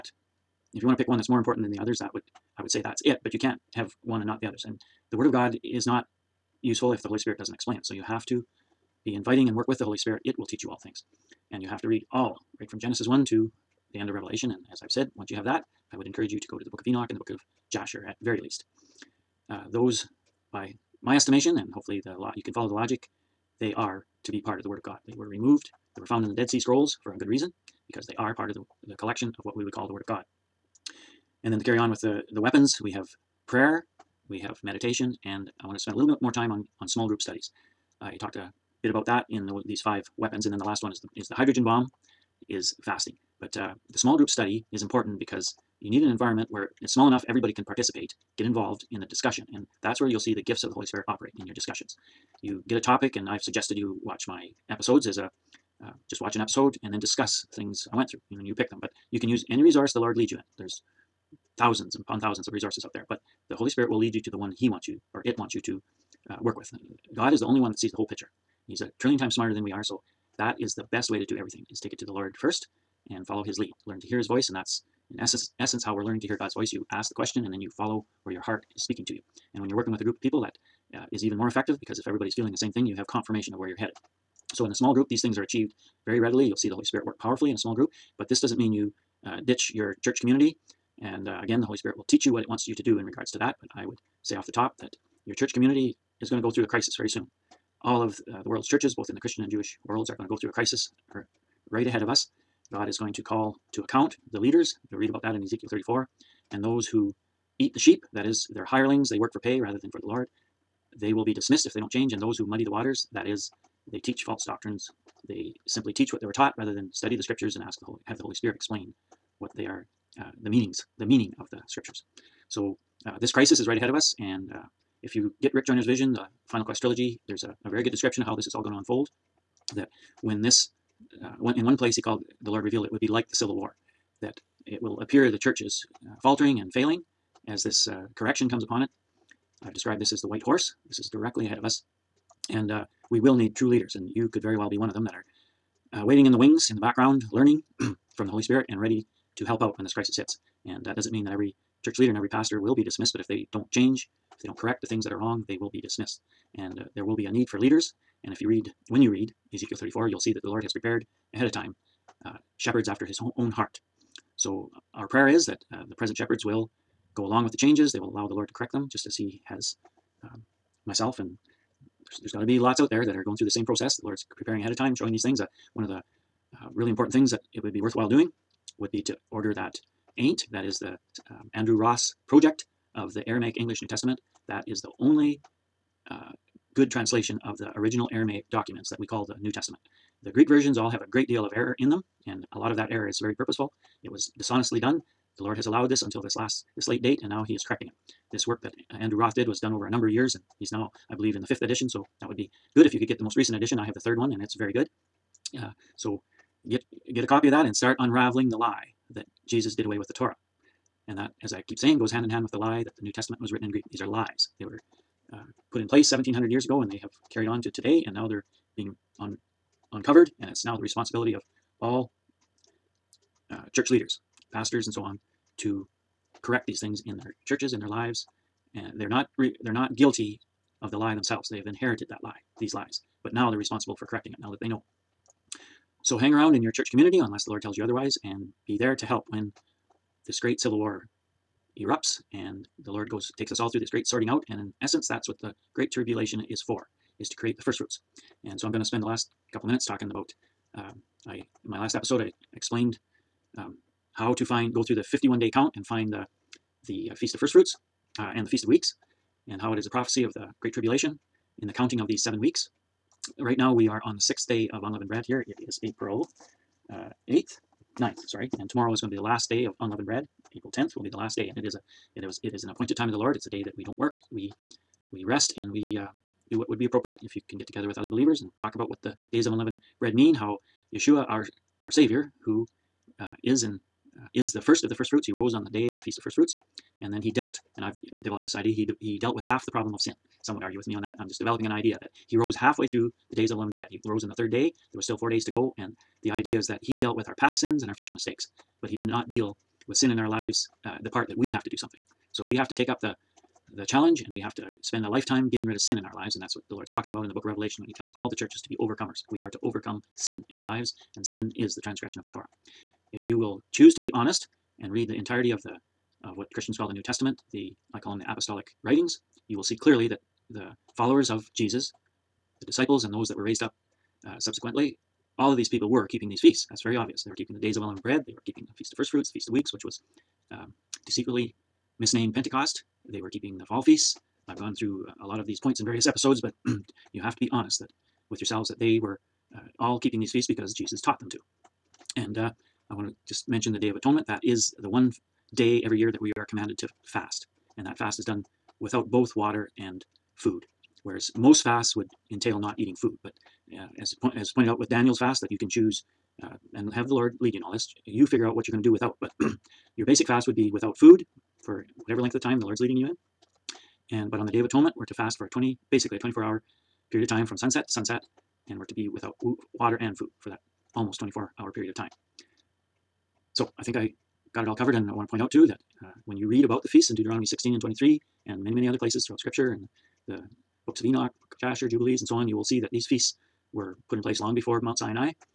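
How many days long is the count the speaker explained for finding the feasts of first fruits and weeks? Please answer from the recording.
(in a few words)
51 day.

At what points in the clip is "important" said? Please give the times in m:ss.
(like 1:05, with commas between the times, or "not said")
0:01, 0:44, 2:56.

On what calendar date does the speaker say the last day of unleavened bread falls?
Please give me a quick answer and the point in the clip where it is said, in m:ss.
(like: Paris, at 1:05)
April 10th, at 4:30.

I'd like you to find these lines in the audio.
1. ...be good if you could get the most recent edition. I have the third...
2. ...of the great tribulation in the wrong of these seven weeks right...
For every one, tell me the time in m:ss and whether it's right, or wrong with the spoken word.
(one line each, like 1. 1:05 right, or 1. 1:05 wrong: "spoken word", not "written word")
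1. 3:22 right
2. 4:20 wrong: "counting", not "wrong".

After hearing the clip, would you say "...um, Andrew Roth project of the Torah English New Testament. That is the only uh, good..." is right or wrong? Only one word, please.
wrong.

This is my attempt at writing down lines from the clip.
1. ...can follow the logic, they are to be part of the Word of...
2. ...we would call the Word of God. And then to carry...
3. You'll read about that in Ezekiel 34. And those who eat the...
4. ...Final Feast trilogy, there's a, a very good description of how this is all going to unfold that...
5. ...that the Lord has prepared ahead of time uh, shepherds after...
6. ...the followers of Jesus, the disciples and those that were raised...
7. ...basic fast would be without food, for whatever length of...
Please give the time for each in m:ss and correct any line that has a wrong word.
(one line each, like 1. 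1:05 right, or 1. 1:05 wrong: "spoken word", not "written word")
1. 0:22 right
2. 0:29 right
3. 1:44 right
4. 2:06 wrong: "Quest", not "Feast"
5. 2:40 right
6. 5:20 right
7. 6:00 right.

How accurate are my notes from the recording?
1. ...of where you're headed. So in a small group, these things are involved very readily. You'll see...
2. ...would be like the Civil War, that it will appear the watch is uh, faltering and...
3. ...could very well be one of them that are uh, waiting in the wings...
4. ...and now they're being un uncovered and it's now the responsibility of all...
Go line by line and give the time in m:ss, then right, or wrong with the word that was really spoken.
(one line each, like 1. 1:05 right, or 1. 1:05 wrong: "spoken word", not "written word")
1. 1:23 wrong: "achieved", not "involved"
2. 2:12 wrong: "church", not "watch"
3. 2:24 right
4. 3:38 right.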